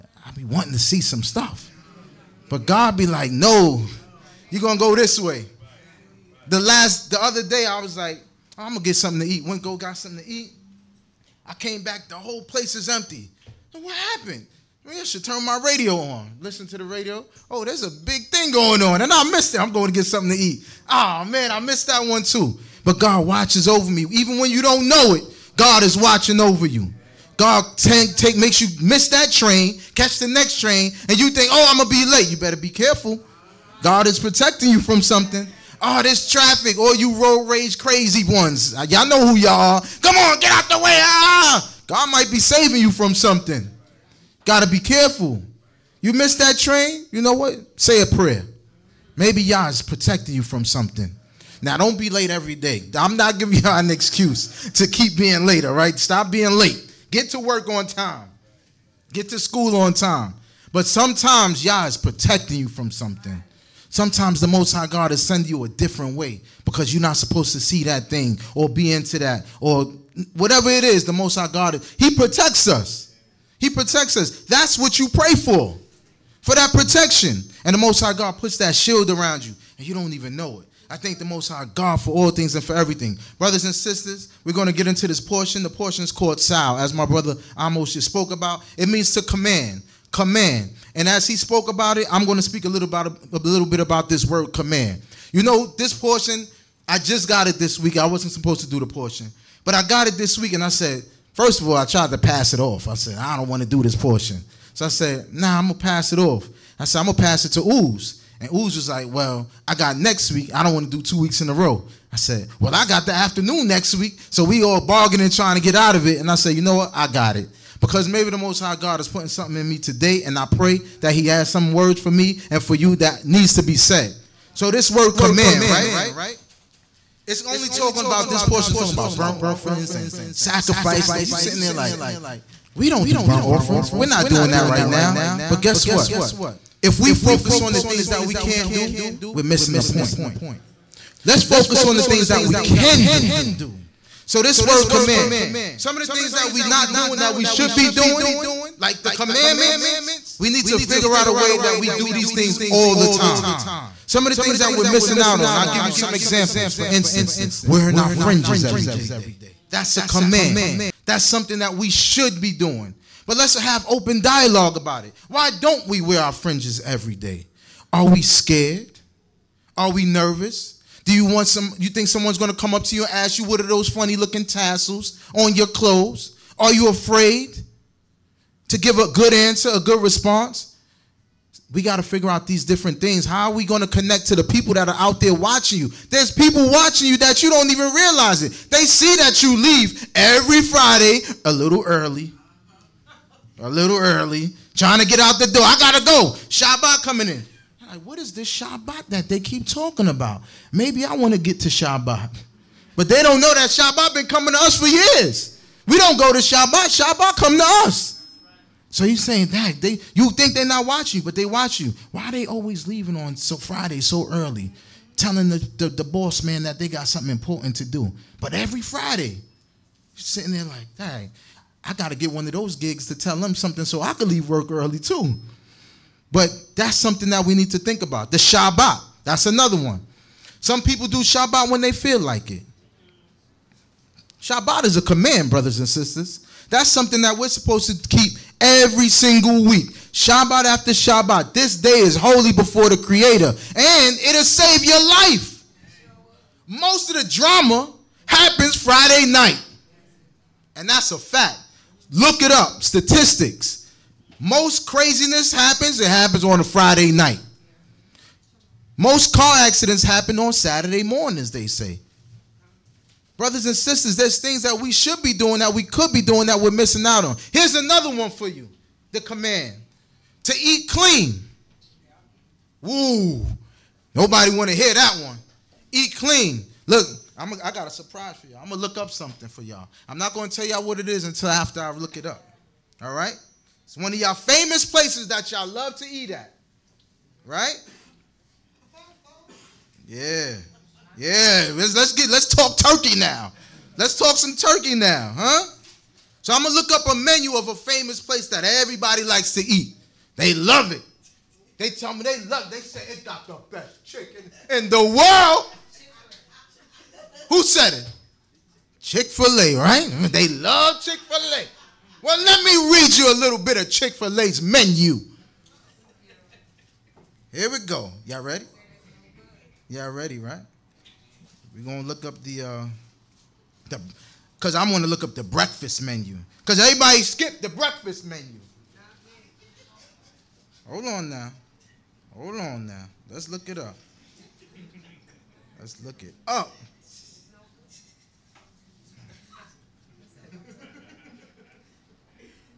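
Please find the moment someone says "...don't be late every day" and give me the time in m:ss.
0:51.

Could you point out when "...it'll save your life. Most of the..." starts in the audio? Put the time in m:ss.
4:04.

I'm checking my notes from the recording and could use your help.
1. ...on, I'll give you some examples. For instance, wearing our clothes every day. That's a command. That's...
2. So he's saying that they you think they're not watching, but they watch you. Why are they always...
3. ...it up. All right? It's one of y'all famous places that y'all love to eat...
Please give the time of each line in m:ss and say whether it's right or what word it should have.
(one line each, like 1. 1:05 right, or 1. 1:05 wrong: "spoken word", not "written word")
1. 2:35 wrong: "fringes", not "clothes"
2. 3:28 right
3. 4:42 right.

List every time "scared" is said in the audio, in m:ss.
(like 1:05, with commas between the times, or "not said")
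2:48.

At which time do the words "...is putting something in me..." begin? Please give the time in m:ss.
1:58.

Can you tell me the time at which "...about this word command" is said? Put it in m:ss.
1:33.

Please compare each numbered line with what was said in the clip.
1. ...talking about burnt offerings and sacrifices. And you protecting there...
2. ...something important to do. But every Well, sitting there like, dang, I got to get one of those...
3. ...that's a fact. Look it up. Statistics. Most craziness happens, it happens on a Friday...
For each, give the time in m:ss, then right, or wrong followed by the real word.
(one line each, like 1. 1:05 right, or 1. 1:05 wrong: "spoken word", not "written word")
1. 2:08 wrong: "sitting", not "protecting"
2. 3:37 wrong: "Friday", not "Well"
3. 4:10 right.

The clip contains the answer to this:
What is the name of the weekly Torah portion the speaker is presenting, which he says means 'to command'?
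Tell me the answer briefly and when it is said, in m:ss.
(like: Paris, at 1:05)
Tzaw, at 1:26.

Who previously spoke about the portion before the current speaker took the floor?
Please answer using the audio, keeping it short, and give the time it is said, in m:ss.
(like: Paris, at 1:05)
Amoz, at 1:27.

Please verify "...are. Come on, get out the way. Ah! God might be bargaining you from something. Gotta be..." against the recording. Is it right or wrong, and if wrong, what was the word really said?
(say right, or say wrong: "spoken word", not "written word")
wrong: "saving", not "bargaining".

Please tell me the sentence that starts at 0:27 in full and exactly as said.
God take, take makes you miss that train, catch the next train, and you think, oh, I'm gonna be late.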